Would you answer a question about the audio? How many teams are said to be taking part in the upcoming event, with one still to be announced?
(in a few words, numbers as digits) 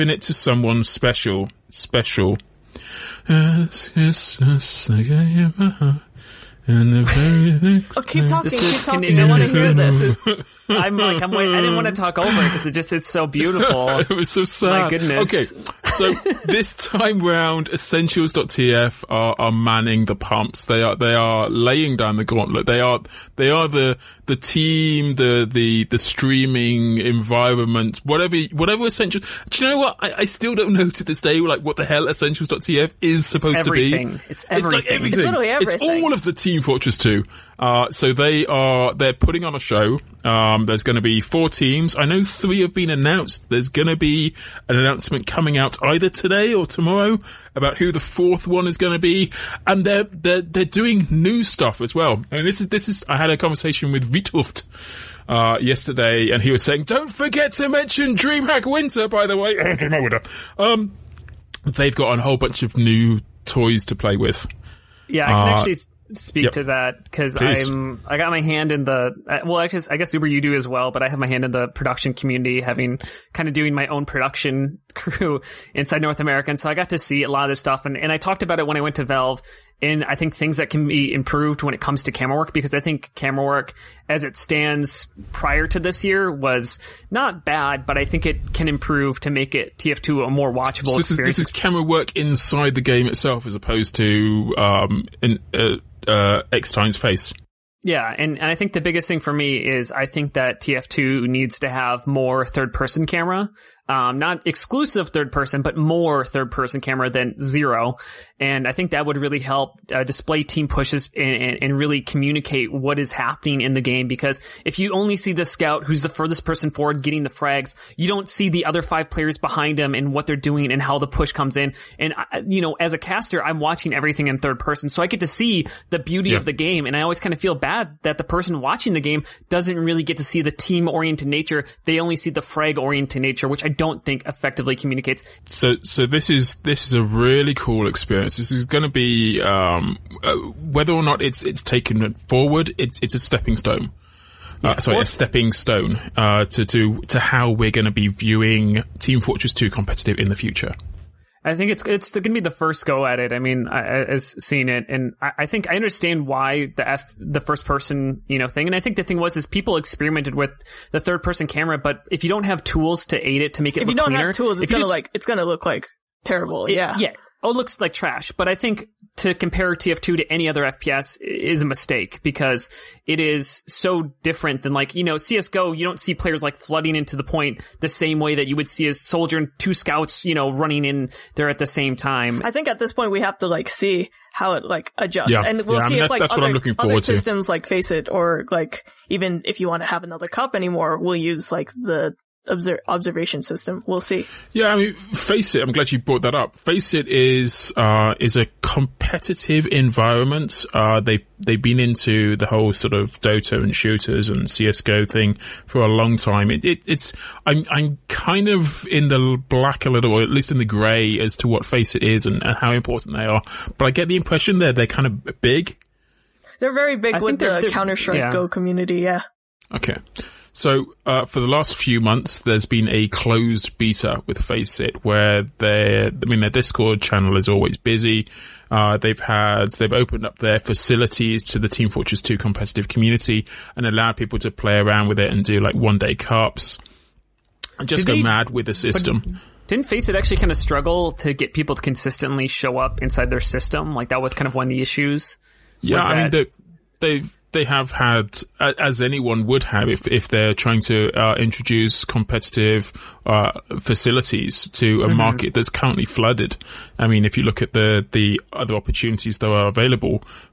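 4.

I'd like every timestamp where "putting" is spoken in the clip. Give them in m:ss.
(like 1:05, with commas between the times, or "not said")
0:39.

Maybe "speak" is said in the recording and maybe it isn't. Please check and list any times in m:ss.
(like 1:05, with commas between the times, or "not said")
1:06.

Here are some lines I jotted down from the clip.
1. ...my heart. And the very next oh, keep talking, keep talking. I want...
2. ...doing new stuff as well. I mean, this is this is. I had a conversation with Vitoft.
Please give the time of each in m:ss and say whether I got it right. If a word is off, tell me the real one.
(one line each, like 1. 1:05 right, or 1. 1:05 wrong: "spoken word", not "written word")
1. 0:05 right
2. 0:50 right.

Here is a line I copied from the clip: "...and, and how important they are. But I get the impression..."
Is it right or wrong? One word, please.
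right.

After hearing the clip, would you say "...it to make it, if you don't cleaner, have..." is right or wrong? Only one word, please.
right.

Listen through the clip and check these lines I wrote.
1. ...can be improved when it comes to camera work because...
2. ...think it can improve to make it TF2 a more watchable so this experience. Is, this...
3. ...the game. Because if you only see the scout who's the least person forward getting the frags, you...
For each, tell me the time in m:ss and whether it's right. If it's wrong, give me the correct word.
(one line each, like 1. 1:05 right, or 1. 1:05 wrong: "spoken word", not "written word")
1. 1:20 right
2. 1:28 right
3. 1:53 wrong: "furthest", not "least".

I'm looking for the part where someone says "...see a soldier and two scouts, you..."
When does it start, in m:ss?
2:58.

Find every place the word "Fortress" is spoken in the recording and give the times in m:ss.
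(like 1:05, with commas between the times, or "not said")
0:36, 2:29, 3:51.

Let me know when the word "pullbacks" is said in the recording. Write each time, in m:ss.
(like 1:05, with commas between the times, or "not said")
not said.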